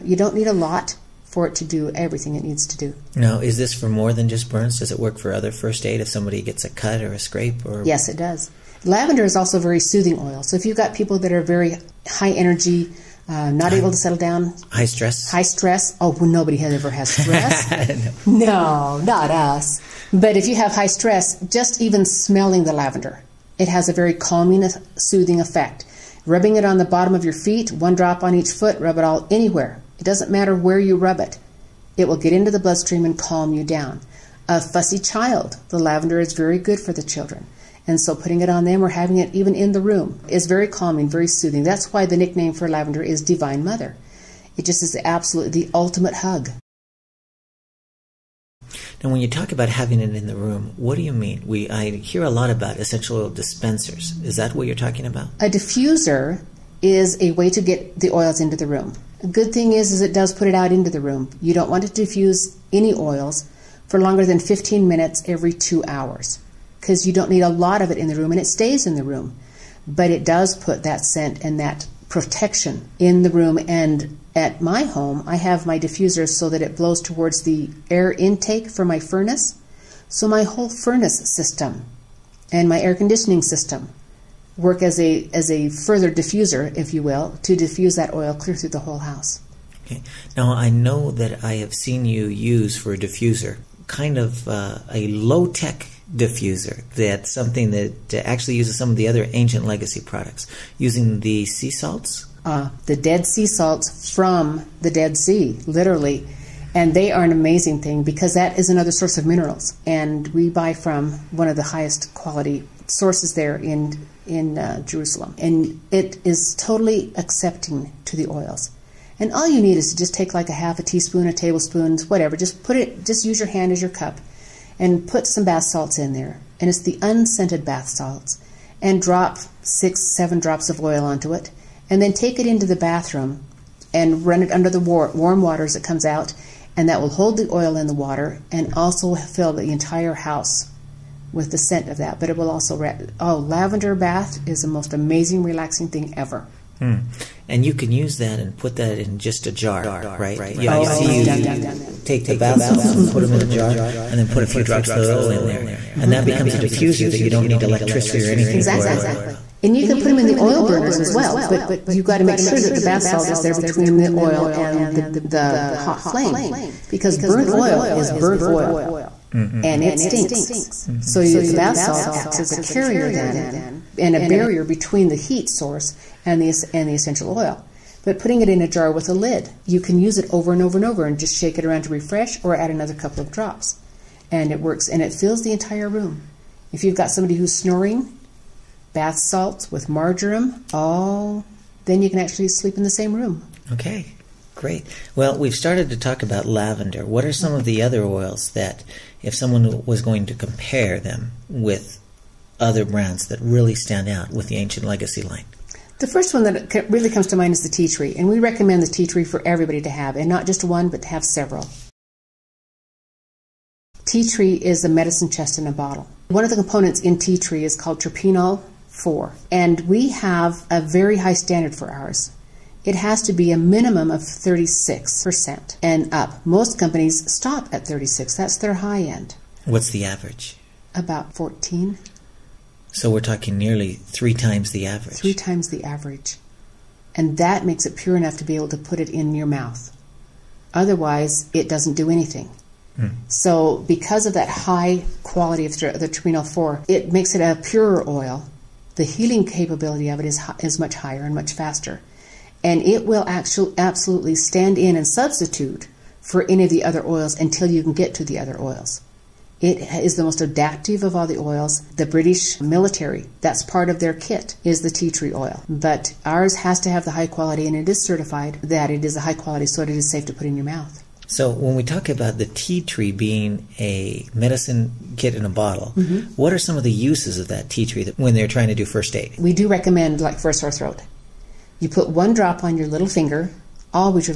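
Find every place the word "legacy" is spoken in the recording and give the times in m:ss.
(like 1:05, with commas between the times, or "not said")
1:39, 3:24.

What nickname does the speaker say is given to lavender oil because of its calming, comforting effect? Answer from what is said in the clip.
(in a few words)
Divine Mother.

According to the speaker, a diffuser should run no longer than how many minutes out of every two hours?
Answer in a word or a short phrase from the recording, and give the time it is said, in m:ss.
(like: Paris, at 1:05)
15 minutes, at 1:04.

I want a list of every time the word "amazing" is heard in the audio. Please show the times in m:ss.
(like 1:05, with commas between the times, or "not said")
1:47, 2:24.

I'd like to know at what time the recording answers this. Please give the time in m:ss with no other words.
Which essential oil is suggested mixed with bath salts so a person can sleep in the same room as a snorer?
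3:09.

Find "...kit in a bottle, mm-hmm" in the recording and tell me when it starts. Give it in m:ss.
4:35.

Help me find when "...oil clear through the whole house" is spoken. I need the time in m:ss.
1:28.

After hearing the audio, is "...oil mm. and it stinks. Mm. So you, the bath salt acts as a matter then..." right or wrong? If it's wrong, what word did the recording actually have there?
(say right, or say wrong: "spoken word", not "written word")
wrong: "carrier", not "matter".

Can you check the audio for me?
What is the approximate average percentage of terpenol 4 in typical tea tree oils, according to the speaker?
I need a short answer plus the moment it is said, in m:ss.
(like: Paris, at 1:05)
14%, at 3:50.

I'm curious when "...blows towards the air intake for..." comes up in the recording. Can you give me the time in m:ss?
1:16.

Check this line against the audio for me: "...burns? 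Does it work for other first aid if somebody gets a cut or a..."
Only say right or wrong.
right.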